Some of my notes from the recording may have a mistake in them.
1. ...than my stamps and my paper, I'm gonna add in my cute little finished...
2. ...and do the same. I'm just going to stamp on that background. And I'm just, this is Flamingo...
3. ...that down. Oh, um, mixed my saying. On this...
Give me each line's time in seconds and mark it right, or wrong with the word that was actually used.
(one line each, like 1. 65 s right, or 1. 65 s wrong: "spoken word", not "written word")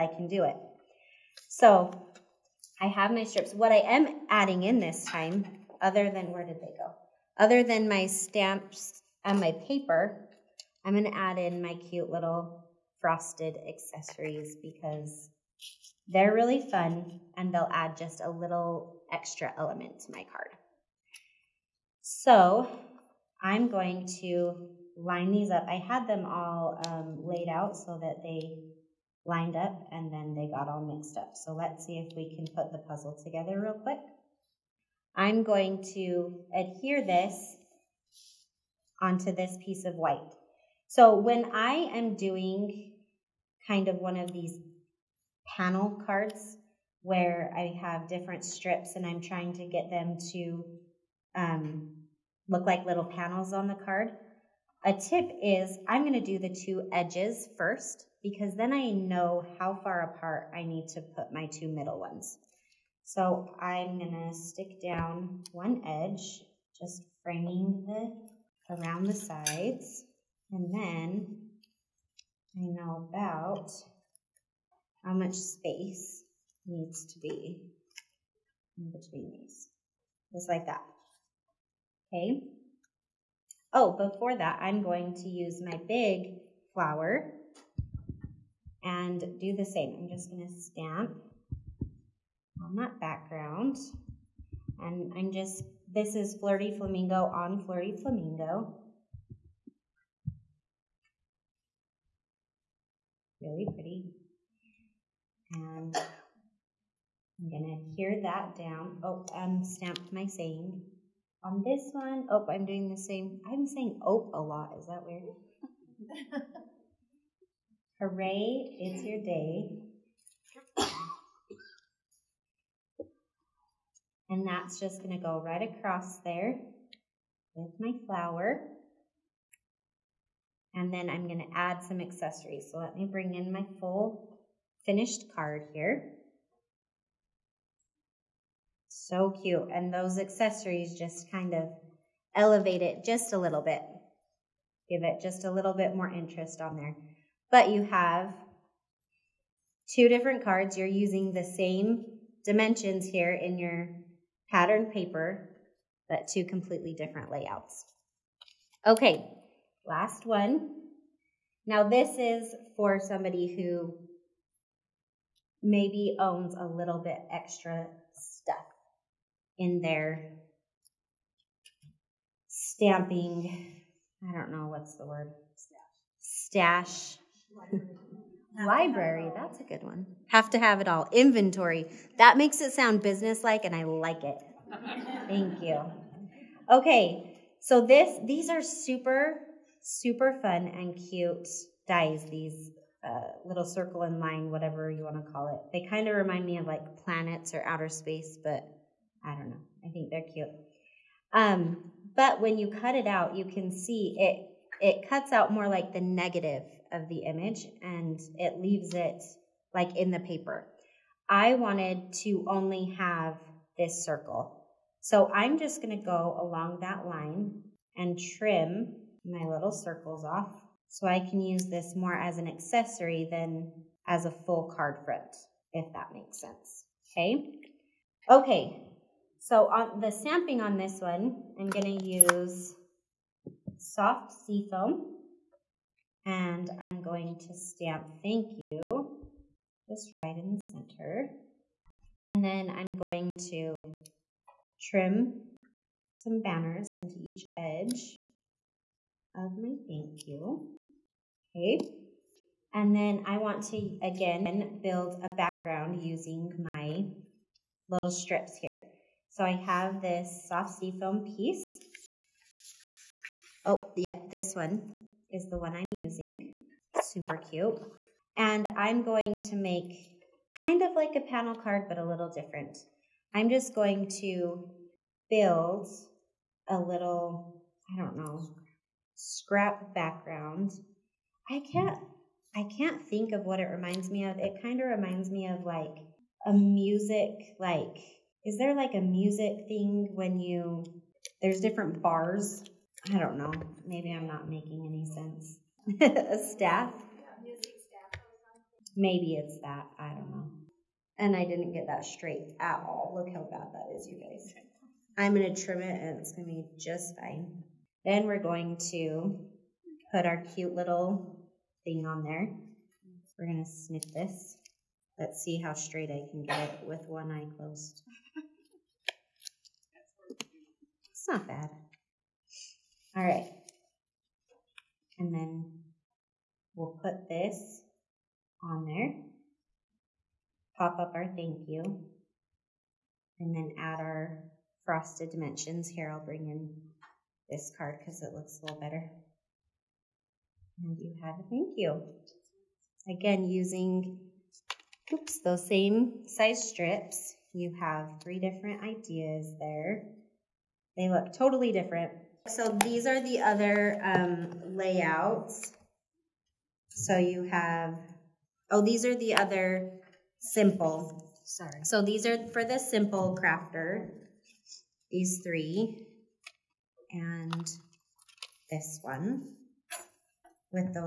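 1. 7 s wrong: "frosted", not "finished"
2. 88 s wrong: "Flirty", not "Flamingo"
3. 108 s wrong: "stamped", not "mixed".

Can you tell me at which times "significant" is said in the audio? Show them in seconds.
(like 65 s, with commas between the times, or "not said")
not said.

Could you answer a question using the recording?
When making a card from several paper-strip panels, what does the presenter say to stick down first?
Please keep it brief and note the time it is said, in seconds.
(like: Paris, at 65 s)
the two edges, at 56 s.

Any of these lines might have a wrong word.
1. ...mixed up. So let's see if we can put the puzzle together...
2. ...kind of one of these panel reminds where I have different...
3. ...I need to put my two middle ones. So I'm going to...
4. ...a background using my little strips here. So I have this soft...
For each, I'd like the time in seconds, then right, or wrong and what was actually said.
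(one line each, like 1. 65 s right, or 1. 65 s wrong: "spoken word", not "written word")
1. 30 s right
2. 43 s wrong: "cards", not "reminds"
3. 60 s right
4. 255 s right.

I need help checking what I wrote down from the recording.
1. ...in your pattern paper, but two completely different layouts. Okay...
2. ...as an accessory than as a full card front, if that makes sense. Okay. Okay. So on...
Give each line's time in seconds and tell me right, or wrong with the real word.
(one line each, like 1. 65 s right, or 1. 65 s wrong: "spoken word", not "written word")
1. 153 s right
2. 222 s right.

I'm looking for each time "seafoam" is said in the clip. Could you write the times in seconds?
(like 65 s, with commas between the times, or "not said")
234 s, 260 s.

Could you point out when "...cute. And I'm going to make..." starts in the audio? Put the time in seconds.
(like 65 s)
267 s.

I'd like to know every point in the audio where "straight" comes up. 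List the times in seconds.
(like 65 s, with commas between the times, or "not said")
302 s, 315 s.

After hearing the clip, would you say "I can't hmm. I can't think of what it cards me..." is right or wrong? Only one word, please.
wrong.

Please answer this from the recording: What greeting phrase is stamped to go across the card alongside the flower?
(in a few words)
Hooray, it's your day.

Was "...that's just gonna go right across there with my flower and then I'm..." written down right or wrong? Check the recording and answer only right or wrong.
right.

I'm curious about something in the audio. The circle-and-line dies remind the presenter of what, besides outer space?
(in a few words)
planets.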